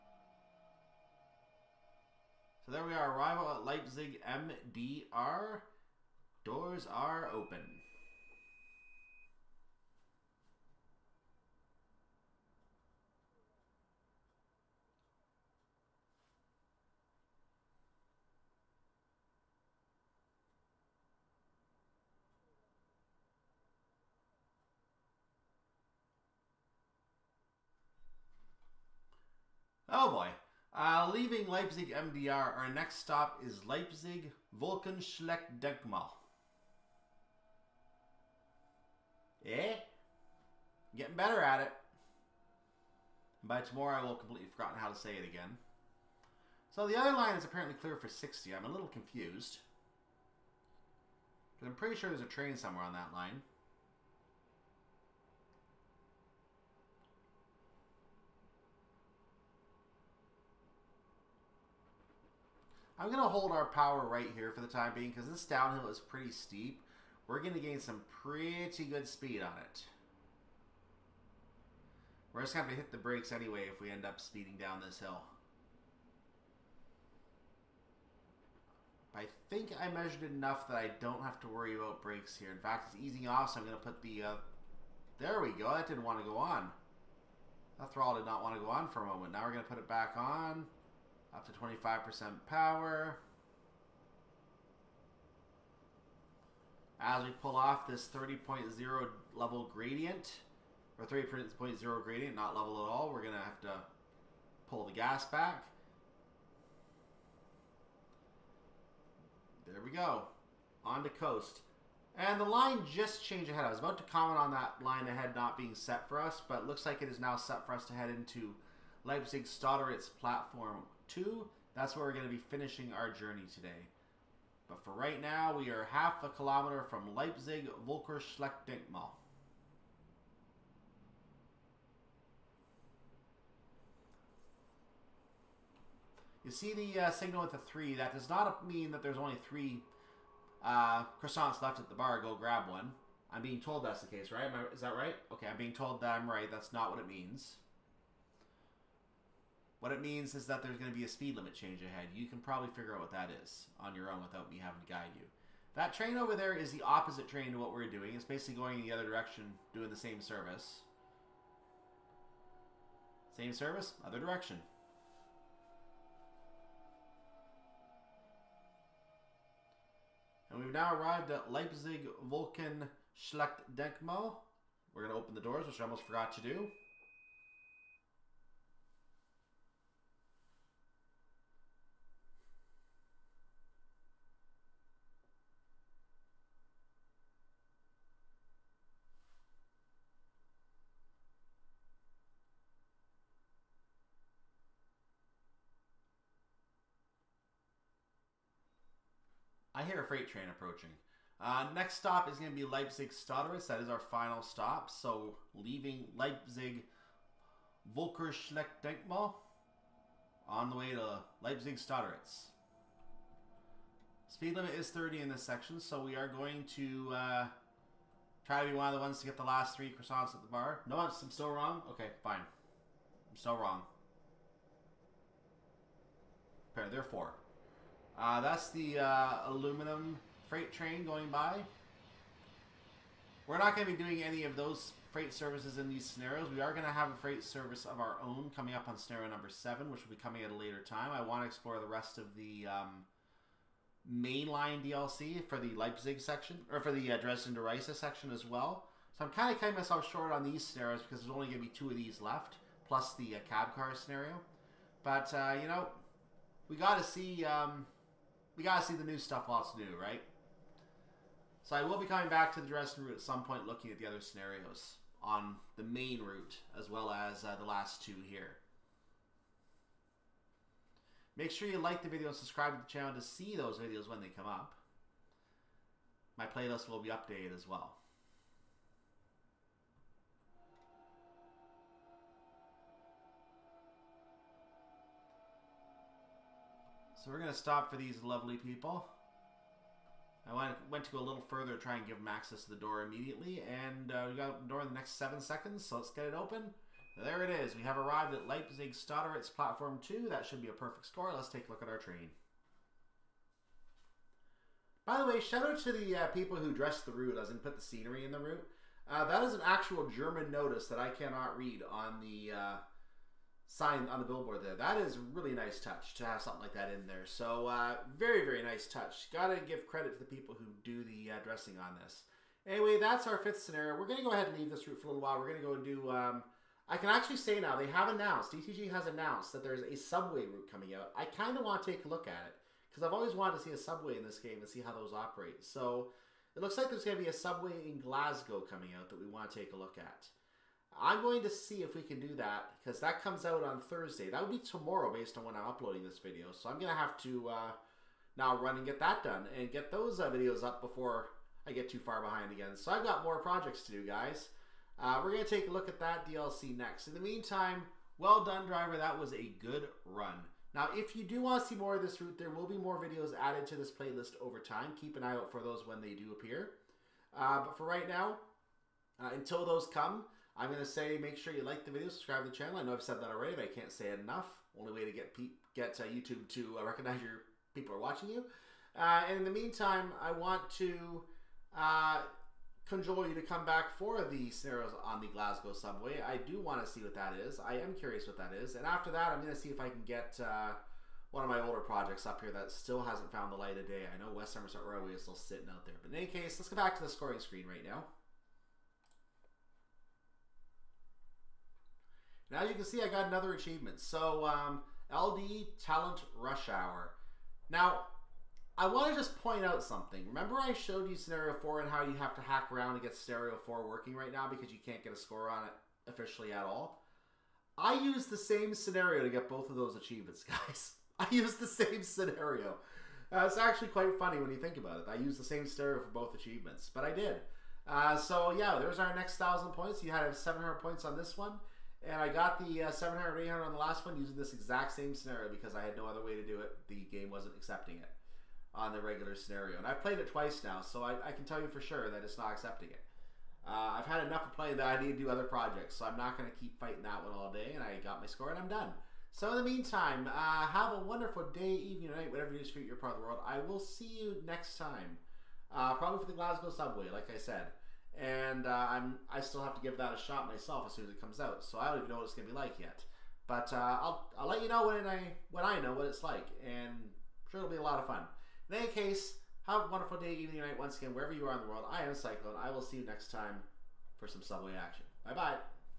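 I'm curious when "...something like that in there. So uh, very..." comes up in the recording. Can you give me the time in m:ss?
5:16.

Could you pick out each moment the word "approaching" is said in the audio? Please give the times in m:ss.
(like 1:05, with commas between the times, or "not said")
3:20.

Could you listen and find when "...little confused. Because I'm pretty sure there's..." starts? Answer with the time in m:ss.
0:48.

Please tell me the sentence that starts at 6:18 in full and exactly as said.
Uh, and in the meantime, I want to uh, conjure you to come back for the scenarios on the Glasgow subway.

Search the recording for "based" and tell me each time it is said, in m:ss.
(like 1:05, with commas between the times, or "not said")
5:45.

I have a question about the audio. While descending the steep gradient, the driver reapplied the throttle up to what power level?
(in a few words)
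25%.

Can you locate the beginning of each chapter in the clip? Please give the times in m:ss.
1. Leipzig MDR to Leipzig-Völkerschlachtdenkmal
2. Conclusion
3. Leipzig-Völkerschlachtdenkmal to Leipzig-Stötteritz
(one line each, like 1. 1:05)
1. 0:26
2. 5:02
3. 3:17.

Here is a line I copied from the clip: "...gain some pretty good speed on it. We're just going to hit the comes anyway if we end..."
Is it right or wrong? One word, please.
wrong.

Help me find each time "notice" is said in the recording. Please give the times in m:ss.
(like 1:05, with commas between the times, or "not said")
5:10.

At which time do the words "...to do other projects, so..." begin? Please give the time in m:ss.
7:25.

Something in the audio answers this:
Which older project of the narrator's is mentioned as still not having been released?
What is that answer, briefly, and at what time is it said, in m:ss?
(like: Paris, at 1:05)
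West Somerset Railway, at 6:34.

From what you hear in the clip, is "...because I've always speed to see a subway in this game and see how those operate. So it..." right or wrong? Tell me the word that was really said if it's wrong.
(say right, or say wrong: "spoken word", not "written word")
wrong: "wanted", not "speed".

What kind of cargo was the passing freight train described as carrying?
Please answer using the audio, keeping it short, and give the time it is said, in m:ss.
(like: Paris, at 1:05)
Aluminum, at 3:49.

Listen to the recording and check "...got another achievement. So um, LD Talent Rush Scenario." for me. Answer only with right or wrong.
wrong.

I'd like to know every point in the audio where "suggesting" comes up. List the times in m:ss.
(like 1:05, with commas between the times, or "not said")
not said.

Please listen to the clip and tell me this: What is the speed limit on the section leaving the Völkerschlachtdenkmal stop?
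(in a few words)
30.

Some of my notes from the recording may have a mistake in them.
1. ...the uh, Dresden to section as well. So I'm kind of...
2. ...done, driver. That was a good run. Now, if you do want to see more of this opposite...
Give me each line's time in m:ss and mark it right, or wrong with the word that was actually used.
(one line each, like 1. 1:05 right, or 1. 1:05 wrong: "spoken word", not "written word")
1. 4:06 right
2. 5:58 wrong: "route", not "opposite".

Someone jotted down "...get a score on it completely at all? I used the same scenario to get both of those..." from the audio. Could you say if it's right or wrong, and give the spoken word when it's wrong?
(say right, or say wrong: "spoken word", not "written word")
wrong: "officially", not "completely".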